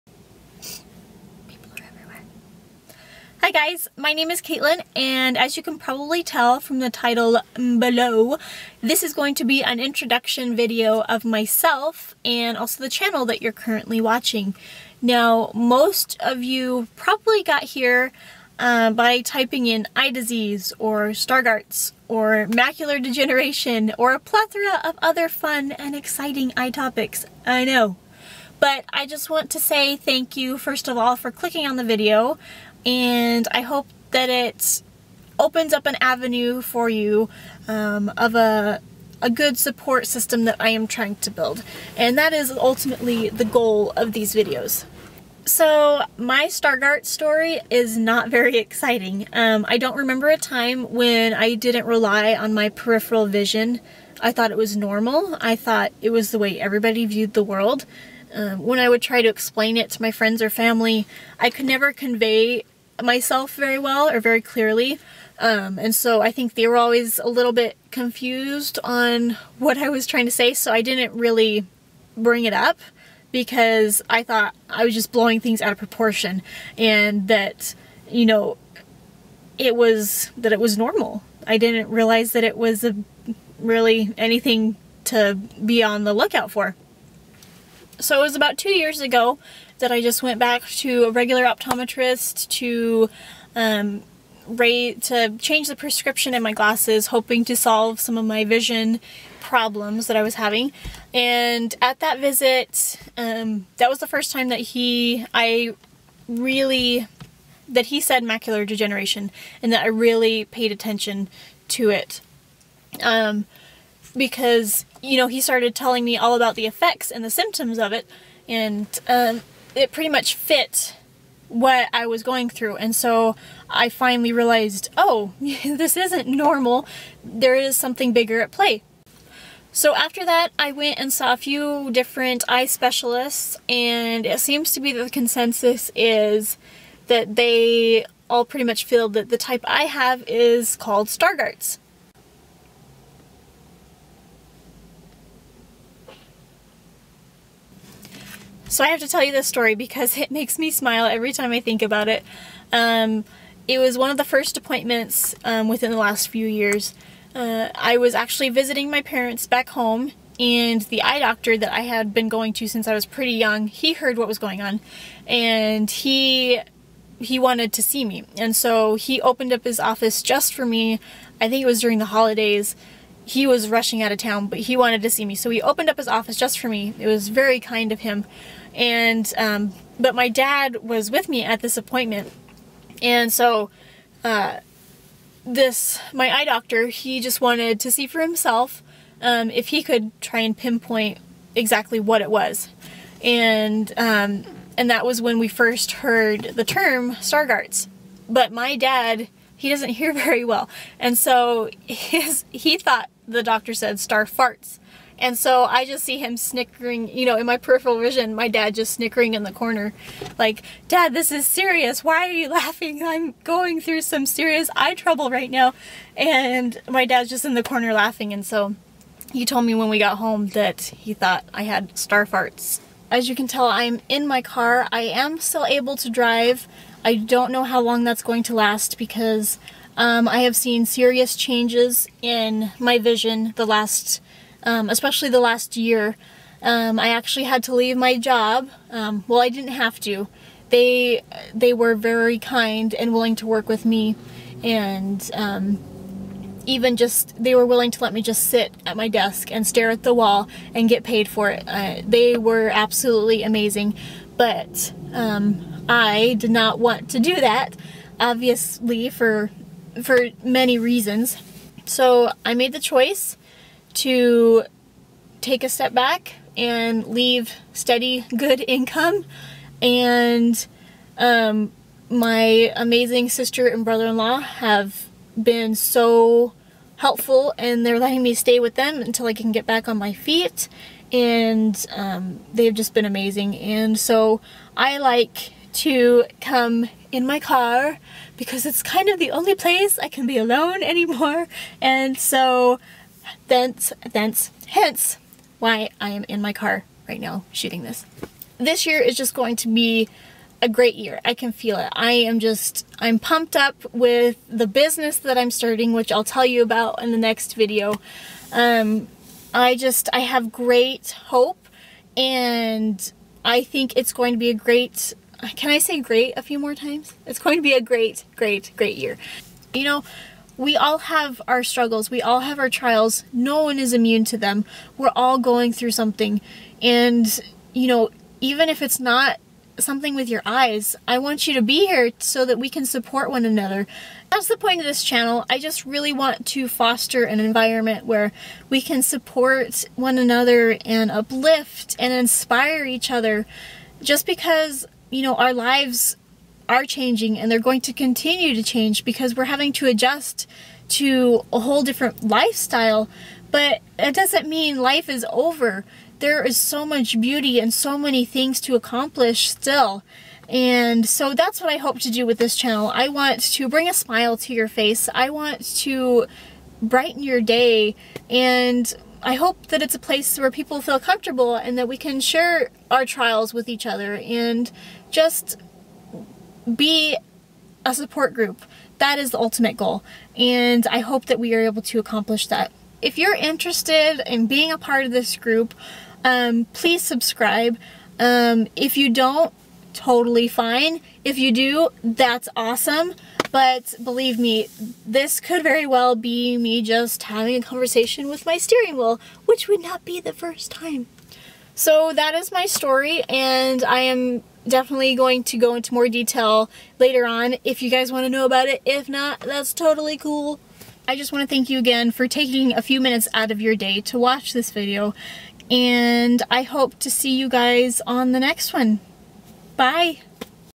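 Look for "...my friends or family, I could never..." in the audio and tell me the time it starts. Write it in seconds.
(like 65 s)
60 s.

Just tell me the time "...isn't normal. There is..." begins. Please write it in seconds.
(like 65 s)
125 s.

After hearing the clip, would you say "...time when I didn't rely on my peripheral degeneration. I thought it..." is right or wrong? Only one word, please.
wrong.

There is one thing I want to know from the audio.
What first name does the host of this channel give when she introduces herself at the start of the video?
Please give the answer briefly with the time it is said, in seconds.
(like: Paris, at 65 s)
Katelynn, at 4 s.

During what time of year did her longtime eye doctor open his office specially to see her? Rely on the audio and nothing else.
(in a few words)
The holidays.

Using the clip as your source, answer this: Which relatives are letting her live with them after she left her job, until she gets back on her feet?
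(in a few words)
Sister and brother-in-law.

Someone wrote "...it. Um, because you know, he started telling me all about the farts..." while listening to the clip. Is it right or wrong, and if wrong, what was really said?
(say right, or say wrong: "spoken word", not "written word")
wrong: "effects", not "farts".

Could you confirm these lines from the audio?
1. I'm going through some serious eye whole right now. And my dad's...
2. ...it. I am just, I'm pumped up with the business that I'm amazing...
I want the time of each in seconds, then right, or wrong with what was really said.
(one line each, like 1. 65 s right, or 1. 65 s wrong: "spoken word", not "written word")
1. 213 s wrong: "trouble", not "whole"
2. 301 s wrong: "starting", not "amazing".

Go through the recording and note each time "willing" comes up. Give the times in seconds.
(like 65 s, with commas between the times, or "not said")
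243 s, 247 s.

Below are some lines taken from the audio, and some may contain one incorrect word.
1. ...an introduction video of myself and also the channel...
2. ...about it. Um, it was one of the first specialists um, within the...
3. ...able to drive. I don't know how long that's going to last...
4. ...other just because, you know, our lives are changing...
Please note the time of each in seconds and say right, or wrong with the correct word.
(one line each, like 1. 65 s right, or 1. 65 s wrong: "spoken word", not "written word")
1. 9 s right
2. 151 s wrong: "appointments", not "specialists"
3. 225 s right
4. 343 s right.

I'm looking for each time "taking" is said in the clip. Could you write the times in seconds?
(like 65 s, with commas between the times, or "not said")
412 s.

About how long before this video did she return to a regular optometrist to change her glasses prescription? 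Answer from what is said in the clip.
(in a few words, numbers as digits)
2 years.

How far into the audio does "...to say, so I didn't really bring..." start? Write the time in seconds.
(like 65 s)
70 s.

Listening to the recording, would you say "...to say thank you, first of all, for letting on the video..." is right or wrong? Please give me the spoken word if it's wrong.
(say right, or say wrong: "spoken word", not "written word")
wrong: "clicking", not "letting".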